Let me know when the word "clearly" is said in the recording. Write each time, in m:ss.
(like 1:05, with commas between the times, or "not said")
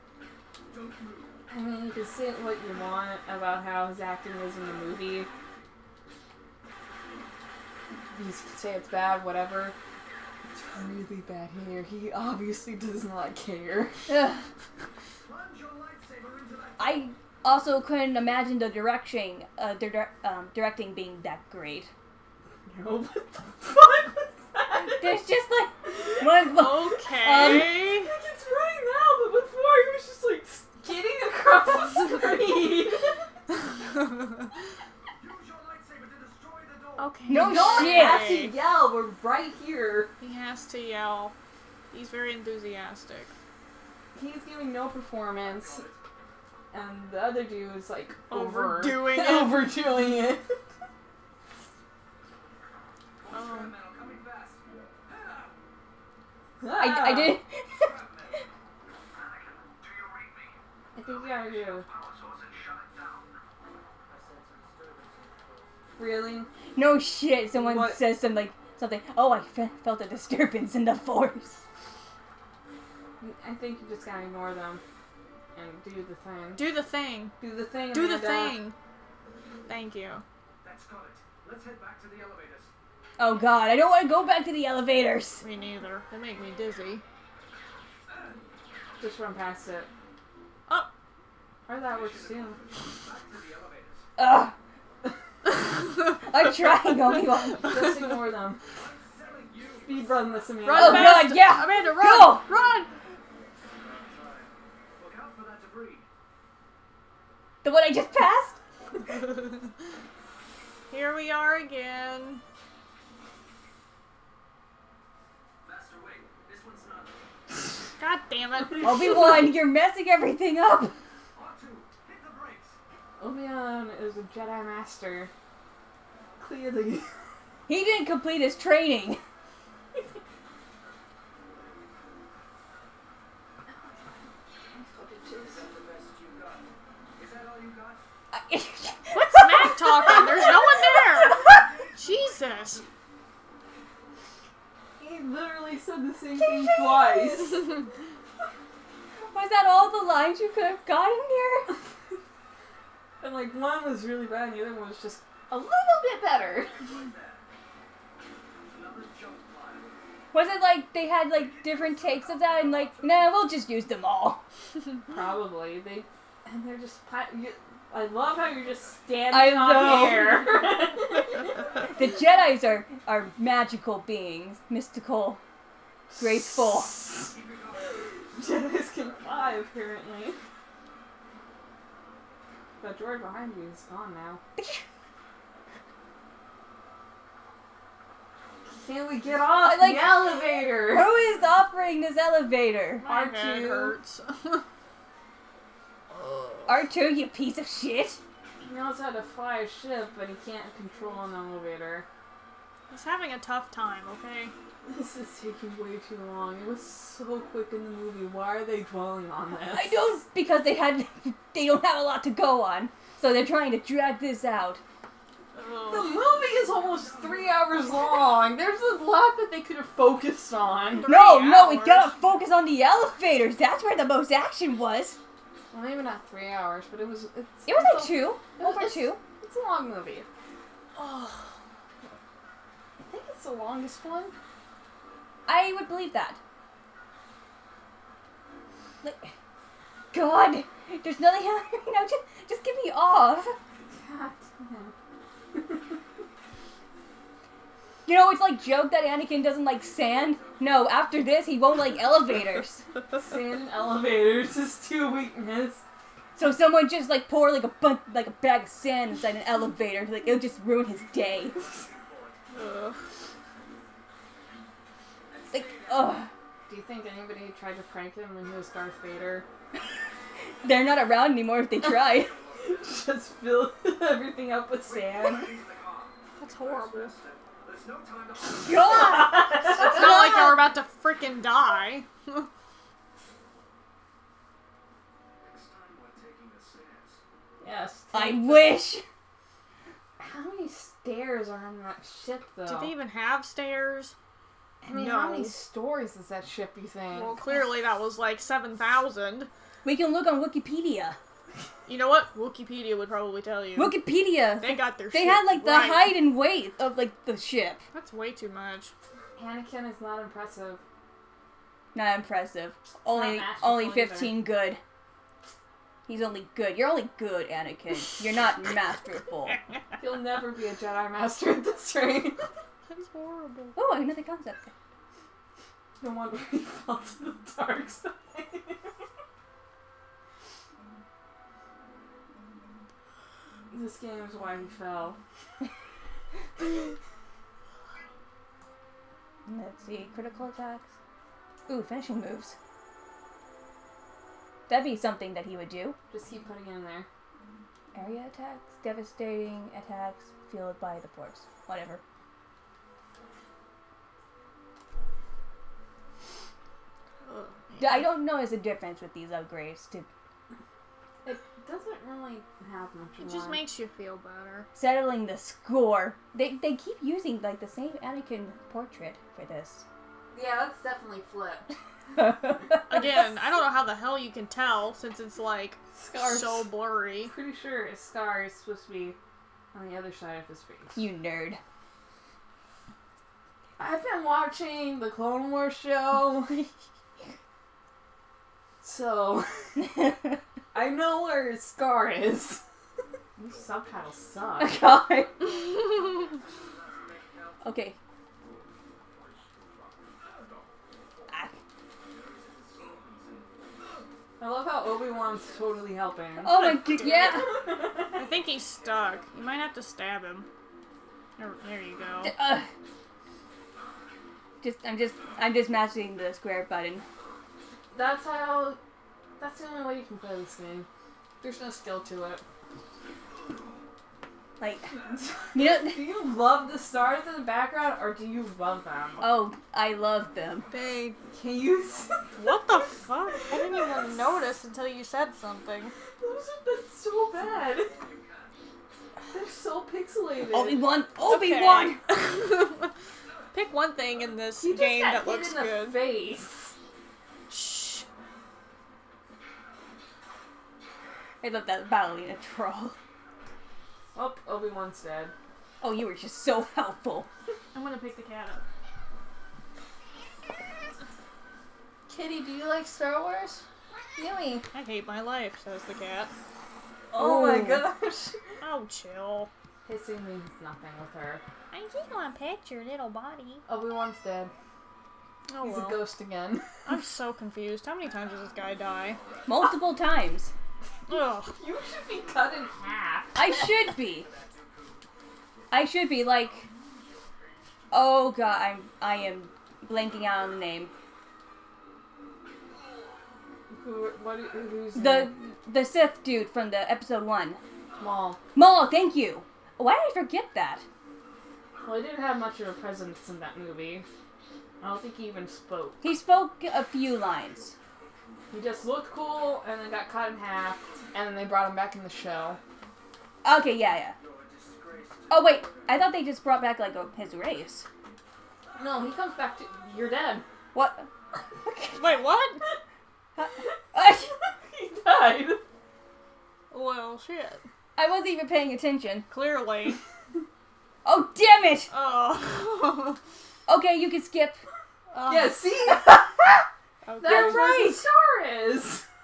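2:06, 4:57, 8:49.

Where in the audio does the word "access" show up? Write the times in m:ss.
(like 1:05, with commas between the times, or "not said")
not said.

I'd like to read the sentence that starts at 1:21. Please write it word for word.
Let's head back to the elevators.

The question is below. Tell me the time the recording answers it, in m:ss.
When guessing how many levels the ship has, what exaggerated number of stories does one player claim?
4:58.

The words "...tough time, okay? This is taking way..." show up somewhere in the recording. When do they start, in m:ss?
3:23.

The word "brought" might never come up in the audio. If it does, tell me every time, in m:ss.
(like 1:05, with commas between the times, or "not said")
8:31, 8:36.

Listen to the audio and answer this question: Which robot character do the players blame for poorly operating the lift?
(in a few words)
R2.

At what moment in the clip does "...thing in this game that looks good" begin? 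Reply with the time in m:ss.
7:23.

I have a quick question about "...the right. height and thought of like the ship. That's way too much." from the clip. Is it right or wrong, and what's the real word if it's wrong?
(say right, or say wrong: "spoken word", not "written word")
wrong: "weight", not "thought".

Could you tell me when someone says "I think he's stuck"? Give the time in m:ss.
6:48.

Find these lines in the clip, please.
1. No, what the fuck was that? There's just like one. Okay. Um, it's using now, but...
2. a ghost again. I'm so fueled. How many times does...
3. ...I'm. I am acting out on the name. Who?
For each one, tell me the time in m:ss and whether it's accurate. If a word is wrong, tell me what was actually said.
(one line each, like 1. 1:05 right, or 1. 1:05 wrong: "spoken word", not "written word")
1. 0:22 wrong: "running", not "using"
2. 7:55 wrong: "confused", not "fueled"
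3. 8:08 wrong: "blanking", not "acting".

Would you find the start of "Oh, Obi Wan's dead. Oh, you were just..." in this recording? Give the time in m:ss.
7:34.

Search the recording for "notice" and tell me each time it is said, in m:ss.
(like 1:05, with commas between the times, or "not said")
5:58, 7:14.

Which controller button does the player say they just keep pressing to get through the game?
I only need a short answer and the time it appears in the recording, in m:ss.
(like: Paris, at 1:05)
square, at 6:56.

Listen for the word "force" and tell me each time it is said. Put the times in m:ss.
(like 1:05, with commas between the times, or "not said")
1:10, 5:51.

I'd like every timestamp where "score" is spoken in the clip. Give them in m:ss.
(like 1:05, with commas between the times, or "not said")
6:05.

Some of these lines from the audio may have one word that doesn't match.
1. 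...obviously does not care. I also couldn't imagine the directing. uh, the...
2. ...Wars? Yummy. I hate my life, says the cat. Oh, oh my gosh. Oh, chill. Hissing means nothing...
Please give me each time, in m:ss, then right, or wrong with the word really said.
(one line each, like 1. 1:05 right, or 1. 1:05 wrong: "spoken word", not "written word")
1. 0:12 right
2. 7:43 right.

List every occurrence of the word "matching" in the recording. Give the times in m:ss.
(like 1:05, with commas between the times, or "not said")
6:55.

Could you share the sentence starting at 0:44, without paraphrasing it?
He's giving no performance, and the other dude is like overdoing it.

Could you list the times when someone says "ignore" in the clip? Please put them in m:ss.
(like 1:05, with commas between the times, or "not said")
1:14, 1:38.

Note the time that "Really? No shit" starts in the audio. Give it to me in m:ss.
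1:05.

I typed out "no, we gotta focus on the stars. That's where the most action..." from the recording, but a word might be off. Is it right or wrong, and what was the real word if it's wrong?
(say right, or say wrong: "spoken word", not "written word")
wrong: "elevators", not "stars".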